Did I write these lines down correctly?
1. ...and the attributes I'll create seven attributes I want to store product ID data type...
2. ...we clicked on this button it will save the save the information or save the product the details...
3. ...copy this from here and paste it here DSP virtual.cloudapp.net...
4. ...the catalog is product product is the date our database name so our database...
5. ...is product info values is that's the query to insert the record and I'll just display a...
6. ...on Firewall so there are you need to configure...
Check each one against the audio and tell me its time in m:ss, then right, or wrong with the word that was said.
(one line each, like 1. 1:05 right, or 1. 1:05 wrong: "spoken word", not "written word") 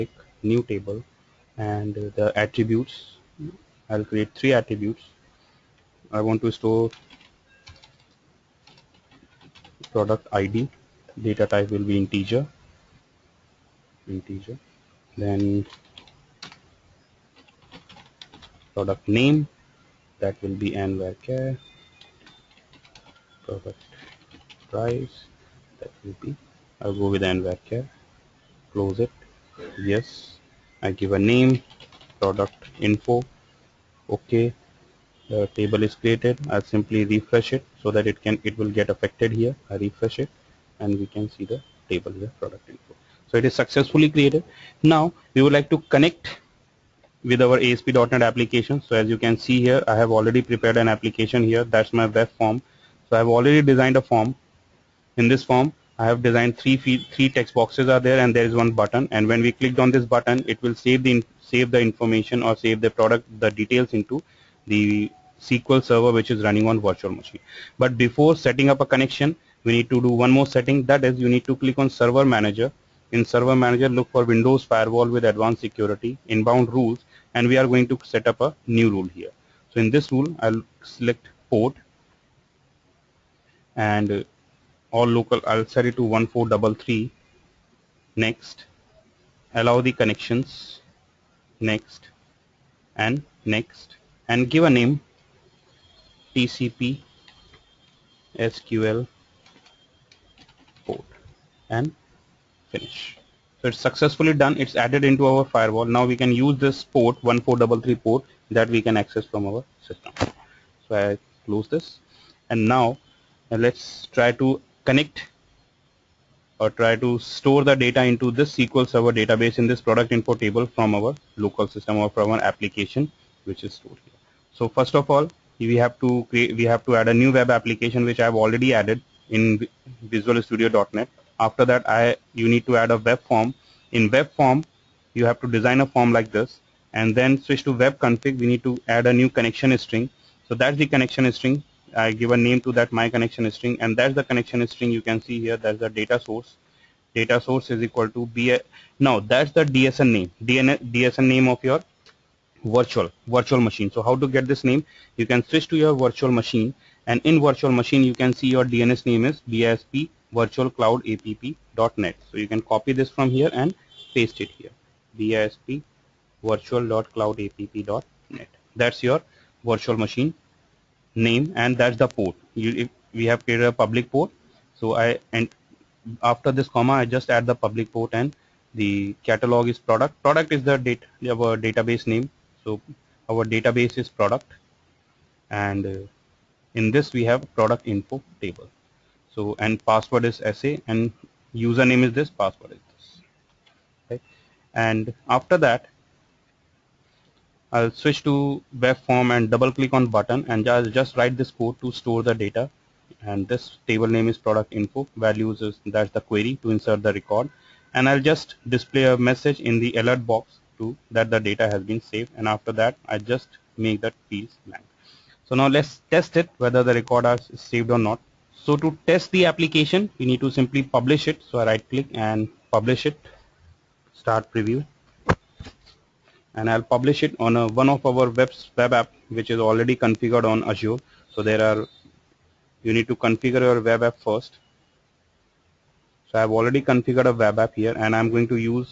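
1. 0:01 wrong: "three", not "seven"
2. 0:59 right
3. 2:42 right
4. 2:58 right
5. 3:24 right
6. 3:50 wrong: "Azure", not "Firewall".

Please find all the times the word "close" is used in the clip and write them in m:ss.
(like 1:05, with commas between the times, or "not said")
0:28, 1:51.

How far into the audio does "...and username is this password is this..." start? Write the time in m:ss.
3:10.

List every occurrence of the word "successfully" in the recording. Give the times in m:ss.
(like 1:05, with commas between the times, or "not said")
0:43, 1:43.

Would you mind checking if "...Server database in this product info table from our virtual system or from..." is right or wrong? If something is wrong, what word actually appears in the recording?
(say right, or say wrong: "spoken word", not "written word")
wrong: "local", not "virtual".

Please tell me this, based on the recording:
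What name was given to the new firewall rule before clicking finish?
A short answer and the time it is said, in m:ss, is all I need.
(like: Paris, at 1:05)
TCP SQL port, at 1:36.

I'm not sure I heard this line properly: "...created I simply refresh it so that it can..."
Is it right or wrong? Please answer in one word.
right.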